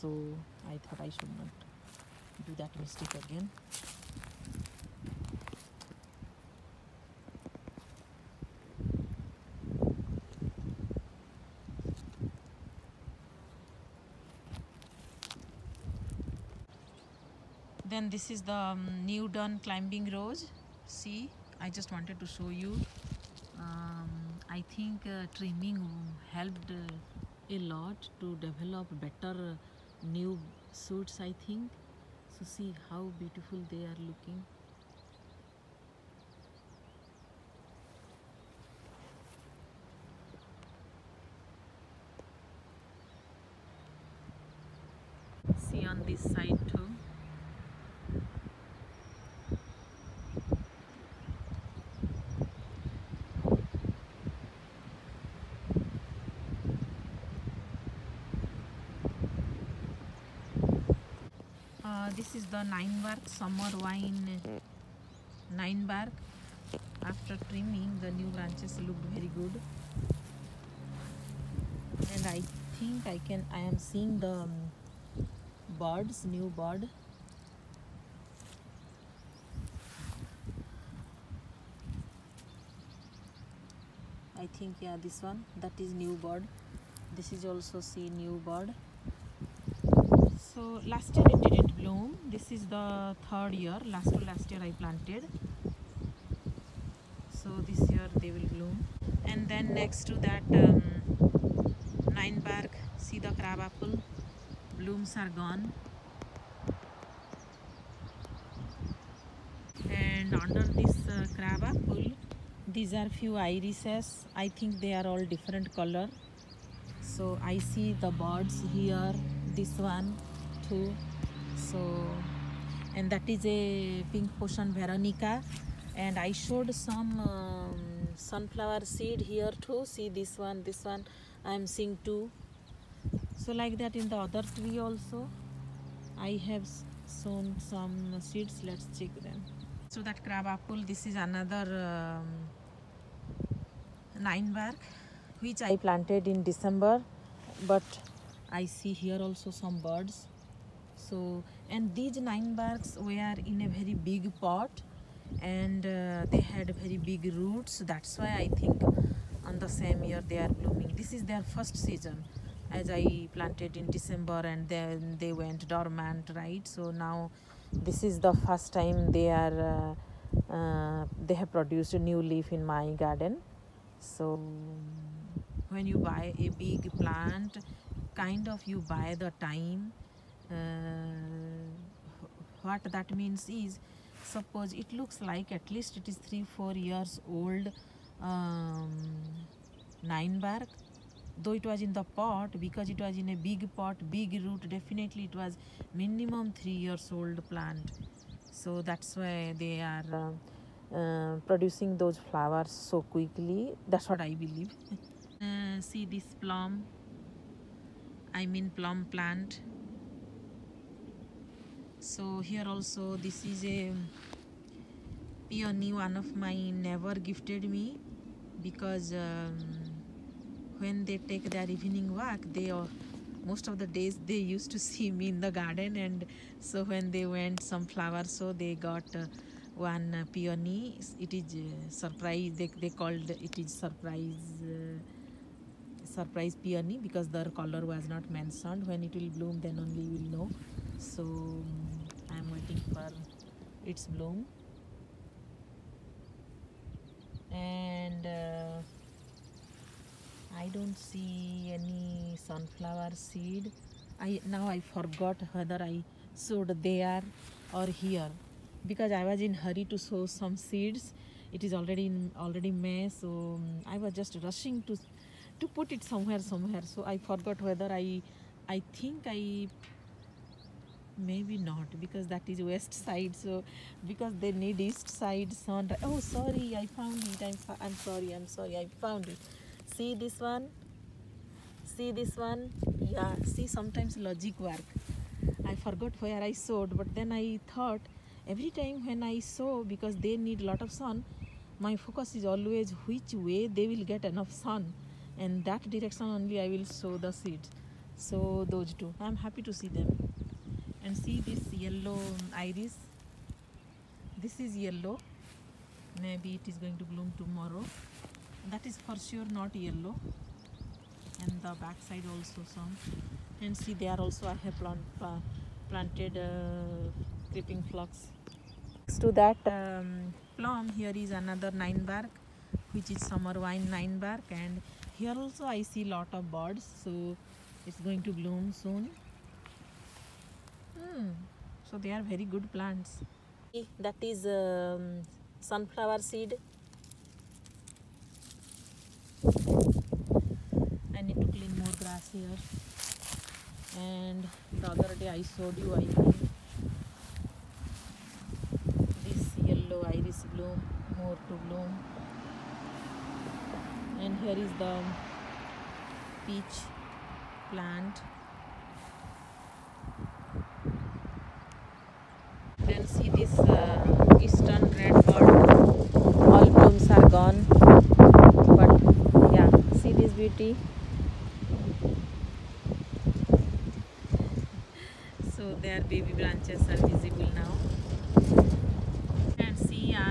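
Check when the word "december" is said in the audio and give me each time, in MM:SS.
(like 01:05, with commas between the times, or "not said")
02:26, 02:43.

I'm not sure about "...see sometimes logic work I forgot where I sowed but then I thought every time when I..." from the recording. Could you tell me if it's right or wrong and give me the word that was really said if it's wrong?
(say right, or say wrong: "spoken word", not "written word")
right.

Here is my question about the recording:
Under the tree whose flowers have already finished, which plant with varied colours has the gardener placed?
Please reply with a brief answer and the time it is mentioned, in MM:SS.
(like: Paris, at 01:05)
irises, at 01:53.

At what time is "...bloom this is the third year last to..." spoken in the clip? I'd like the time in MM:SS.
01:31.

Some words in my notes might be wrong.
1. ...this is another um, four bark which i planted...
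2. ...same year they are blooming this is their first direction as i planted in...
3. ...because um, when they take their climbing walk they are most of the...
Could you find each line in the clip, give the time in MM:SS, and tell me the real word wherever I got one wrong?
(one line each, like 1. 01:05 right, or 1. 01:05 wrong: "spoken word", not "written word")
1. 02:20 wrong: "nine", not "four"
2. 02:39 wrong: "season", not "direction"
3. 03:38 wrong: "evening", not "climbing".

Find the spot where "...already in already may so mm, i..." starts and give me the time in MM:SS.
04:21.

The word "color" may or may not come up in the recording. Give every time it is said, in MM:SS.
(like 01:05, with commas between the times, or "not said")
01:55, 03:57.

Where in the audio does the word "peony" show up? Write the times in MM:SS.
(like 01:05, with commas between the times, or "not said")
03:35, 03:50, 03:56.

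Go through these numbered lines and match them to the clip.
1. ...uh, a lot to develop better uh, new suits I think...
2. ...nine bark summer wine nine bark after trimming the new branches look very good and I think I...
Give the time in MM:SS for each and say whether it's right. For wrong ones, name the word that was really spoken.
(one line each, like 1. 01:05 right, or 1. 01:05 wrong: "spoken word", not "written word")
1. 00:26 right
2. 01:02 right.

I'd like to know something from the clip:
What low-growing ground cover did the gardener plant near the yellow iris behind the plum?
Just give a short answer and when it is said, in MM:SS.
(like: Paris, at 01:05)
creeping phlox, at 05:17.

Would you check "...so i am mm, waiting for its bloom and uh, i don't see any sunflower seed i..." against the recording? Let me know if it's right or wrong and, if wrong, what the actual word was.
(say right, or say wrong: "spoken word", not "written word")
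right.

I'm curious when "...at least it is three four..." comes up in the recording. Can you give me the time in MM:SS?
03:05.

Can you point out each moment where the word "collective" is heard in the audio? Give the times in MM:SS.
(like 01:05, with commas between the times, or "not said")
not said.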